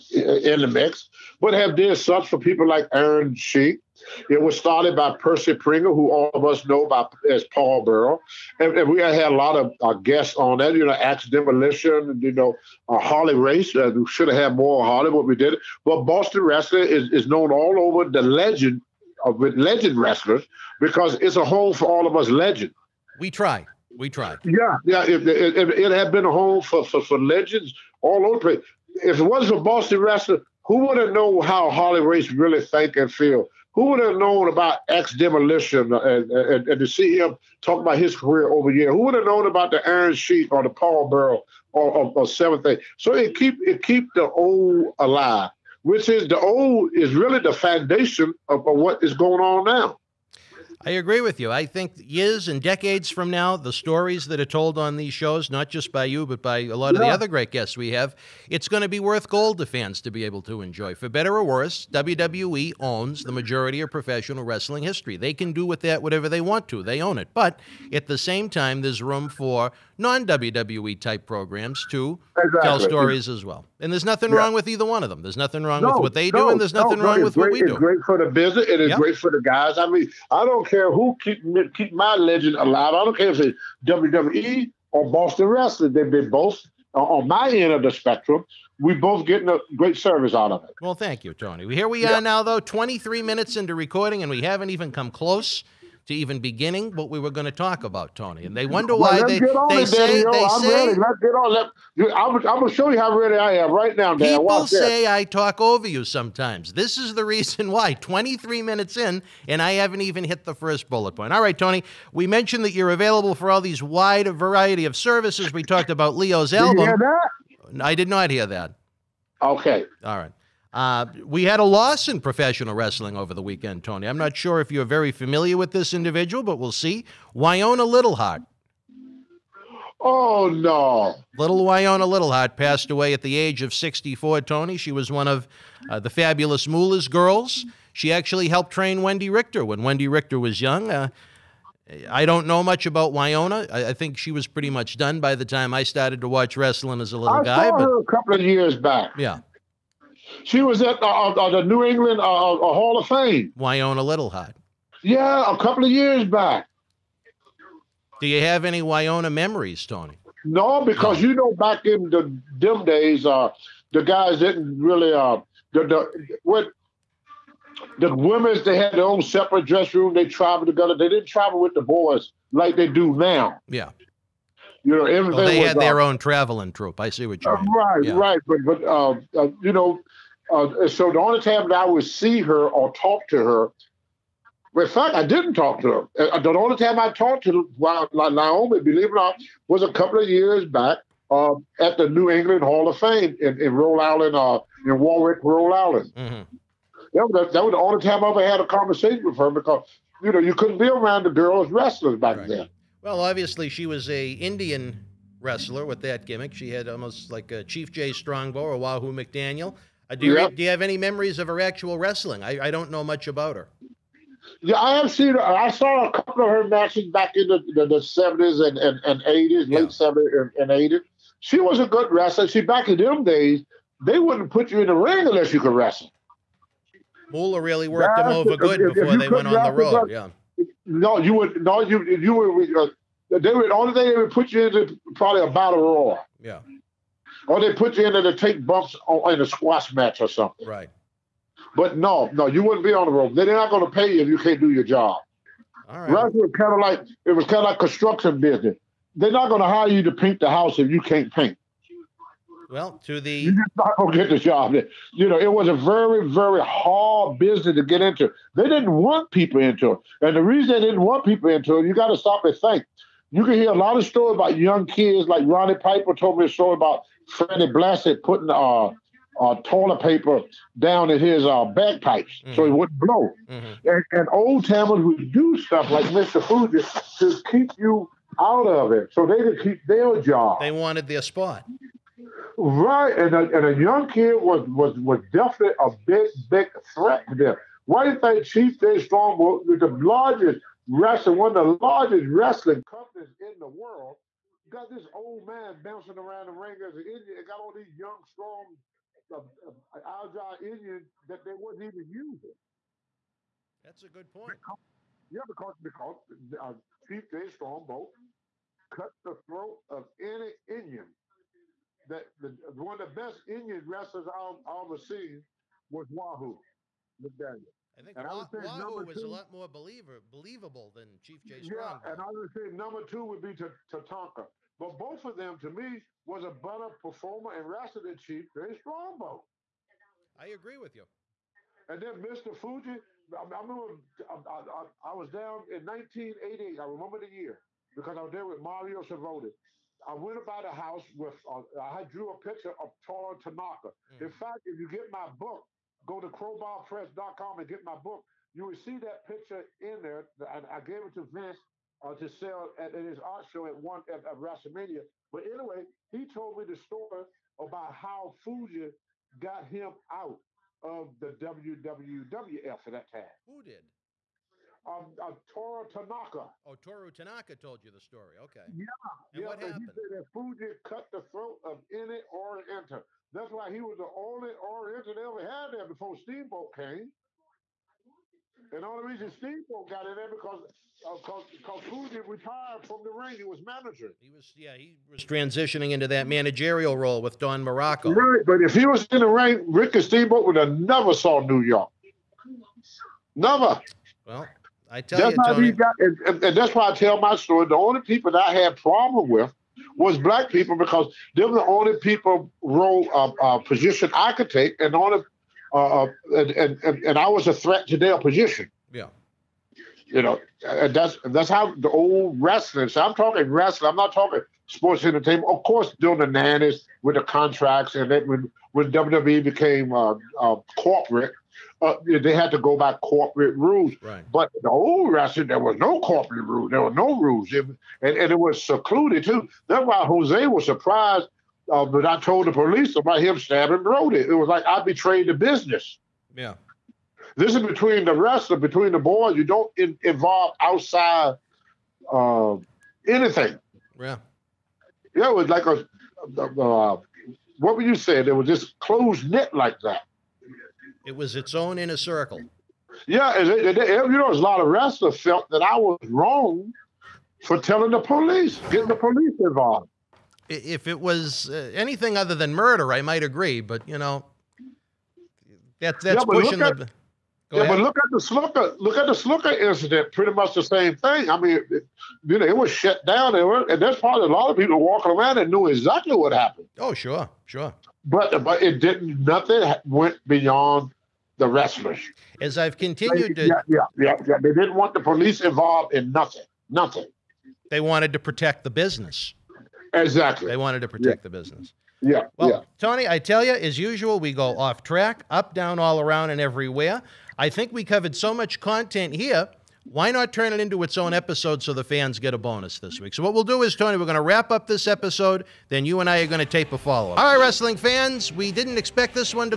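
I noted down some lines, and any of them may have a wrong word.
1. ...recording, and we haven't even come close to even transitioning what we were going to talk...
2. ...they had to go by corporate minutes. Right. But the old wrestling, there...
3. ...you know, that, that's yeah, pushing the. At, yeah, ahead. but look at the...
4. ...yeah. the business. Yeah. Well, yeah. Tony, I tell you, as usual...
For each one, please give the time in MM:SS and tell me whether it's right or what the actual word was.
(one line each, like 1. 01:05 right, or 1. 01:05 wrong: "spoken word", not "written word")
1. 01:33 wrong: "beginning", not "transitioning"
2. 07:02 wrong: "rules", not "minutes"
3. 07:43 right
4. 08:11 right.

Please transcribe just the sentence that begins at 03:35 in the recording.
I saw a couple of her matches back in the, the, the 70s and, and, and 80s, yeah.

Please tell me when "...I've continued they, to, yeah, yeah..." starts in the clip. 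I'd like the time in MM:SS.
08:02.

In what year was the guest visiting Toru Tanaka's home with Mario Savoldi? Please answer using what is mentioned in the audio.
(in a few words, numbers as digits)
1988.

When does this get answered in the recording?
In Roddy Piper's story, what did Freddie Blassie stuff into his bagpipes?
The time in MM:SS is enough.
04:29.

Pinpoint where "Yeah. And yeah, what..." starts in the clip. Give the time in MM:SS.
06:08.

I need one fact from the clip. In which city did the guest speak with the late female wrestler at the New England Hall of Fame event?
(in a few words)
Warwick, Rhode Island.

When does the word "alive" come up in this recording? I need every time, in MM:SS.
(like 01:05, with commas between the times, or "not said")
00:44, 01:22.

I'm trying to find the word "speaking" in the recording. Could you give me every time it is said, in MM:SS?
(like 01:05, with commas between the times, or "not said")
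not said.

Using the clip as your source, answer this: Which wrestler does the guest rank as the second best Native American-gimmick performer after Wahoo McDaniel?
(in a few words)
Tatanka.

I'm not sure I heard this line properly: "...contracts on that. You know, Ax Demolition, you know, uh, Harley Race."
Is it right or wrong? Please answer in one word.
wrong.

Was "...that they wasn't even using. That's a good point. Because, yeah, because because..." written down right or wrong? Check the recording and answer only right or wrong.
right.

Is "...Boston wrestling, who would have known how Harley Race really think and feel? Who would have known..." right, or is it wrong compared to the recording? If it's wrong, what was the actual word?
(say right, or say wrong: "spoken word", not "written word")
right.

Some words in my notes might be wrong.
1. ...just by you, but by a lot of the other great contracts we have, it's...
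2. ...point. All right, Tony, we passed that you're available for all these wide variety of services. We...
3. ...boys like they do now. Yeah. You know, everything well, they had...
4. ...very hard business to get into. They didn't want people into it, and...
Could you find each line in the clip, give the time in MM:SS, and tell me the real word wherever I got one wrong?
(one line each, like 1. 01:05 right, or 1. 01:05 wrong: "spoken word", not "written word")
1. 00:55 wrong: "guests", not "contracts"
2. 01:51 wrong: "mentioned", not "passed"
3. 02:51 right
4. 04:16 right.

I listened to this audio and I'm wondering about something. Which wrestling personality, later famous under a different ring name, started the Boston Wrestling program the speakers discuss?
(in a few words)
Percy Pringle.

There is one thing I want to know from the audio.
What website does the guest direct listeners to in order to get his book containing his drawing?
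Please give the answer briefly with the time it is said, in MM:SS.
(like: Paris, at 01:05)
crowbarpress.com, at 05:46.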